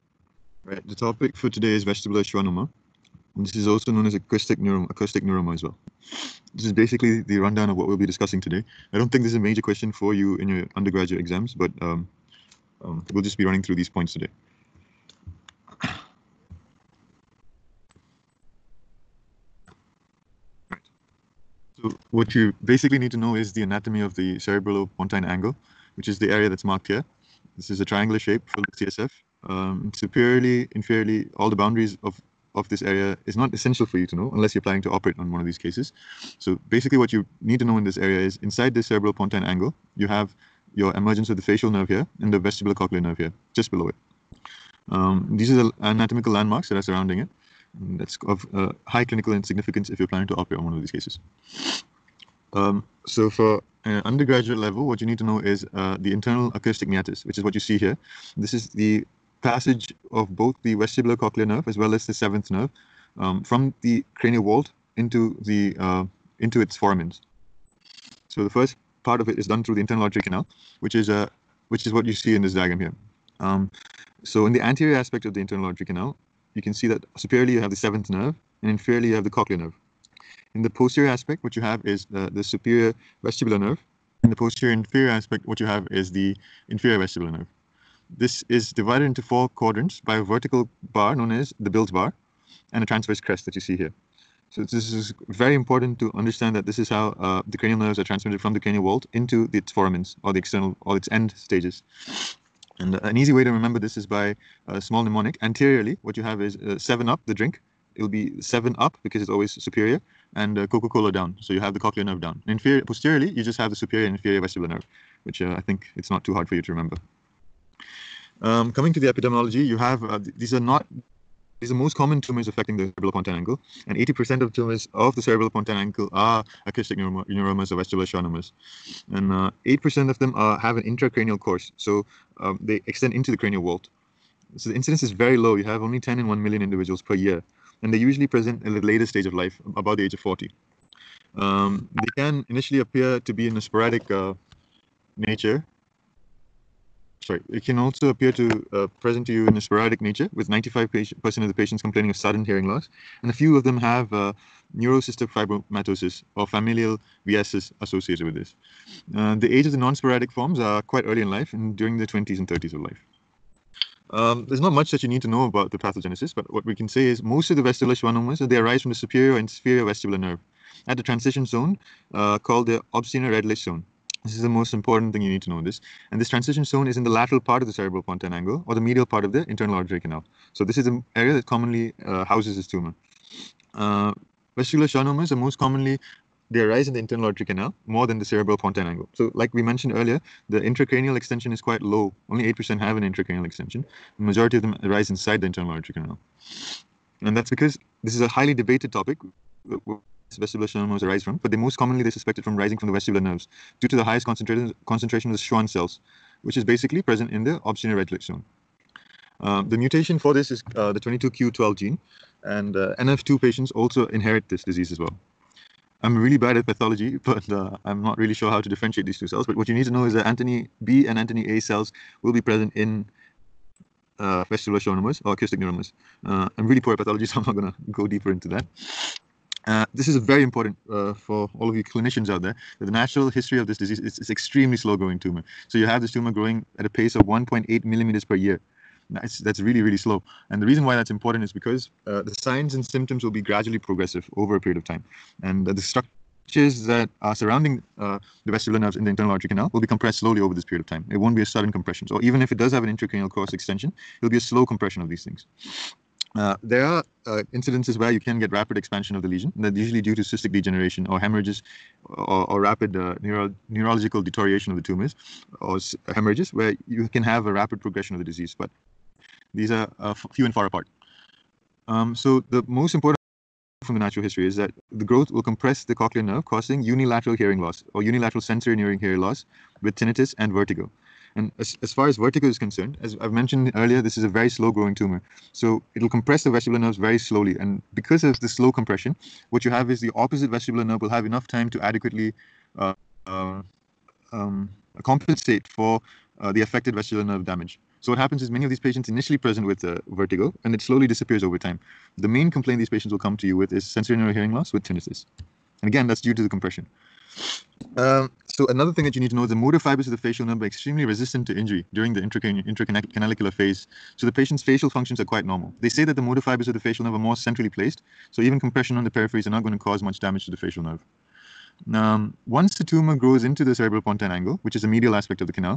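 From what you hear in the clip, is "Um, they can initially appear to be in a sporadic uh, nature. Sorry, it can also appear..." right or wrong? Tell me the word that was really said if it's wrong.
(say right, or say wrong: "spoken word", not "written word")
right.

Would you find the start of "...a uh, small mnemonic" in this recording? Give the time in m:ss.
1:44.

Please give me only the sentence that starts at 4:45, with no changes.
So it'll compress the vestibular nerves very slowly.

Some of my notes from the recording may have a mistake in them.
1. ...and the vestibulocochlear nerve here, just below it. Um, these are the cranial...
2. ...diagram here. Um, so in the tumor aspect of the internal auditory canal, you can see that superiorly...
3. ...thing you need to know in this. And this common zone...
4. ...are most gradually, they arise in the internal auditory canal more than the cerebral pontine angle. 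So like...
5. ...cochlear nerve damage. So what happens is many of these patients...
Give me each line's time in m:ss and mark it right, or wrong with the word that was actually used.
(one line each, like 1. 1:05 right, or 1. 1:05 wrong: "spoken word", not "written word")
1. 0:42 wrong: "anatomical", not "cranial"
2. 1:12 wrong: "anterior", not "tumor"
3. 2:55 wrong: "transition", not "common"
4. 3:05 wrong: "commonly", not "gradually"
5. 4:56 wrong: "vestibular", not "cochlear".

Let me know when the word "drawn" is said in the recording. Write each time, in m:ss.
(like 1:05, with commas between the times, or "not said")
not said.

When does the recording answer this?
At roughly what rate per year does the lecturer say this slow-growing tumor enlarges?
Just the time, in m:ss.
3:57.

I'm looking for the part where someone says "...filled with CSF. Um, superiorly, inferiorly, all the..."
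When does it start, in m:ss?
0:28.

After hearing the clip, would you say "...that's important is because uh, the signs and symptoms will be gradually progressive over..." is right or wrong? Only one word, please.
right.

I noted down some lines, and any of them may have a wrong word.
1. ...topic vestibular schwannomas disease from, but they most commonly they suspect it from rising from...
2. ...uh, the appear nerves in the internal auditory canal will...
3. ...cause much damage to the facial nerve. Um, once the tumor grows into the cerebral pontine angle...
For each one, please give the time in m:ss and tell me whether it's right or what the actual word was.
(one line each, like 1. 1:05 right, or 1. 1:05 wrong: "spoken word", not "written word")
1. 3:18 wrong: "arise", not "disease"
2. 4:07 wrong: "vestibular", not "appear"
3. 5:19 right.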